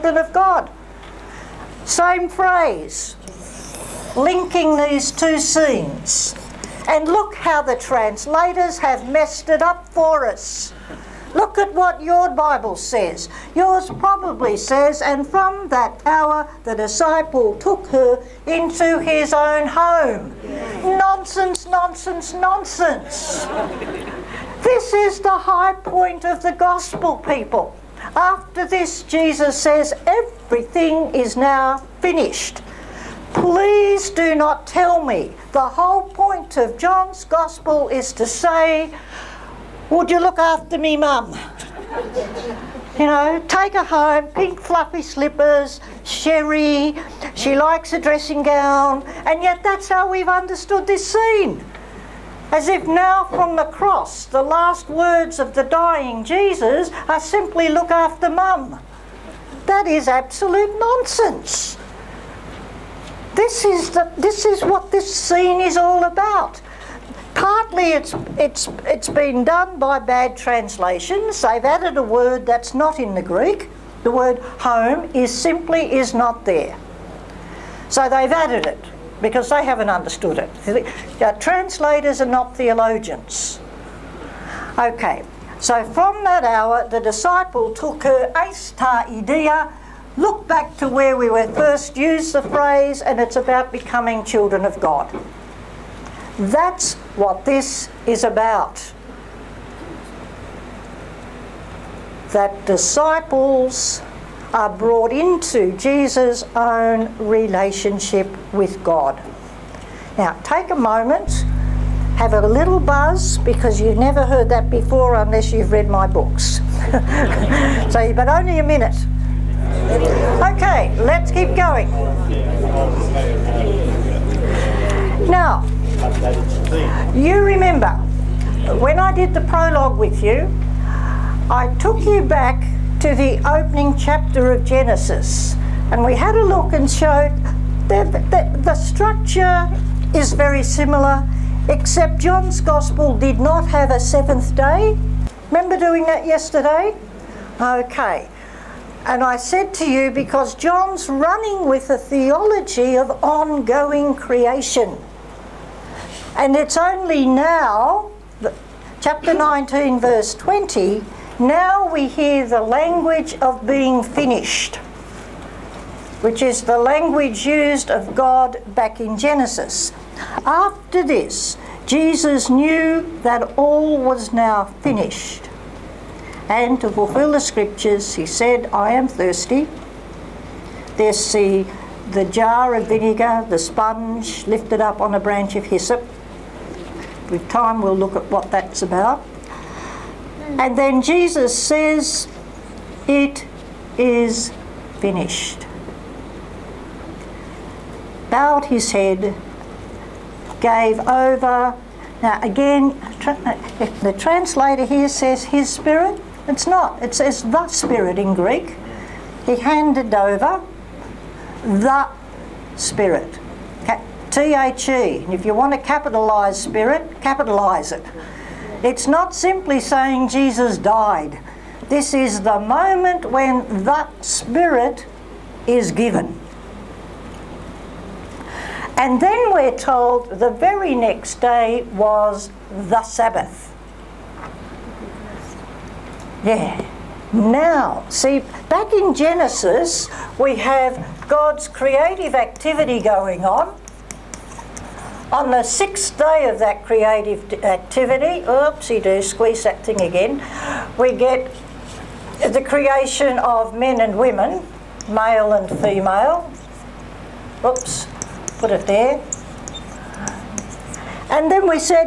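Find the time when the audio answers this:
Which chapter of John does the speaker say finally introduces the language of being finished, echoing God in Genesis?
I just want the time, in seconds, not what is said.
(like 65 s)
159 s.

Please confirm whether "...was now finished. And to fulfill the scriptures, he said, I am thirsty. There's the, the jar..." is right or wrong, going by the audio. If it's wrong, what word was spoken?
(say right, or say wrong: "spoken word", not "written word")
right.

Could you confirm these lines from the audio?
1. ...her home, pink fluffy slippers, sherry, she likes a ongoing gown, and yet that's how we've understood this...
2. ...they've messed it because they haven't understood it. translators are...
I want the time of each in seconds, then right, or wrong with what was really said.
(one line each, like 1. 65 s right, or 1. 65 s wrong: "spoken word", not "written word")
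1. 43 s wrong: "dressing", not "ongoing"
2. 78 s wrong: "added", not "messed".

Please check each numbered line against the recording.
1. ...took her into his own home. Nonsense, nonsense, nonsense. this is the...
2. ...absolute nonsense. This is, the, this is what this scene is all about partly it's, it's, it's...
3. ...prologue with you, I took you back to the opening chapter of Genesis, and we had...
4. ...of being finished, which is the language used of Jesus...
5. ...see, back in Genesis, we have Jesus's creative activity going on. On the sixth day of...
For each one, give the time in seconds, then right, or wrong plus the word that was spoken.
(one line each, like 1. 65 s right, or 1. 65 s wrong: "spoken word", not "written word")
1. 17 s right
2. 60 s right
3. 129 s right
4. 163 s wrong: "God", not "Jesus"
5. 238 s wrong: "God", not "Jesus".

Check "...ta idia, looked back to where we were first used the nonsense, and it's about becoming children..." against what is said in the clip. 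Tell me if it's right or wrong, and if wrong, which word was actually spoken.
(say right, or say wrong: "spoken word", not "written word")
wrong: "phrase", not "nonsense".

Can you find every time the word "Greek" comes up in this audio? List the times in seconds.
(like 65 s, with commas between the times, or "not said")
73 s, 208 s.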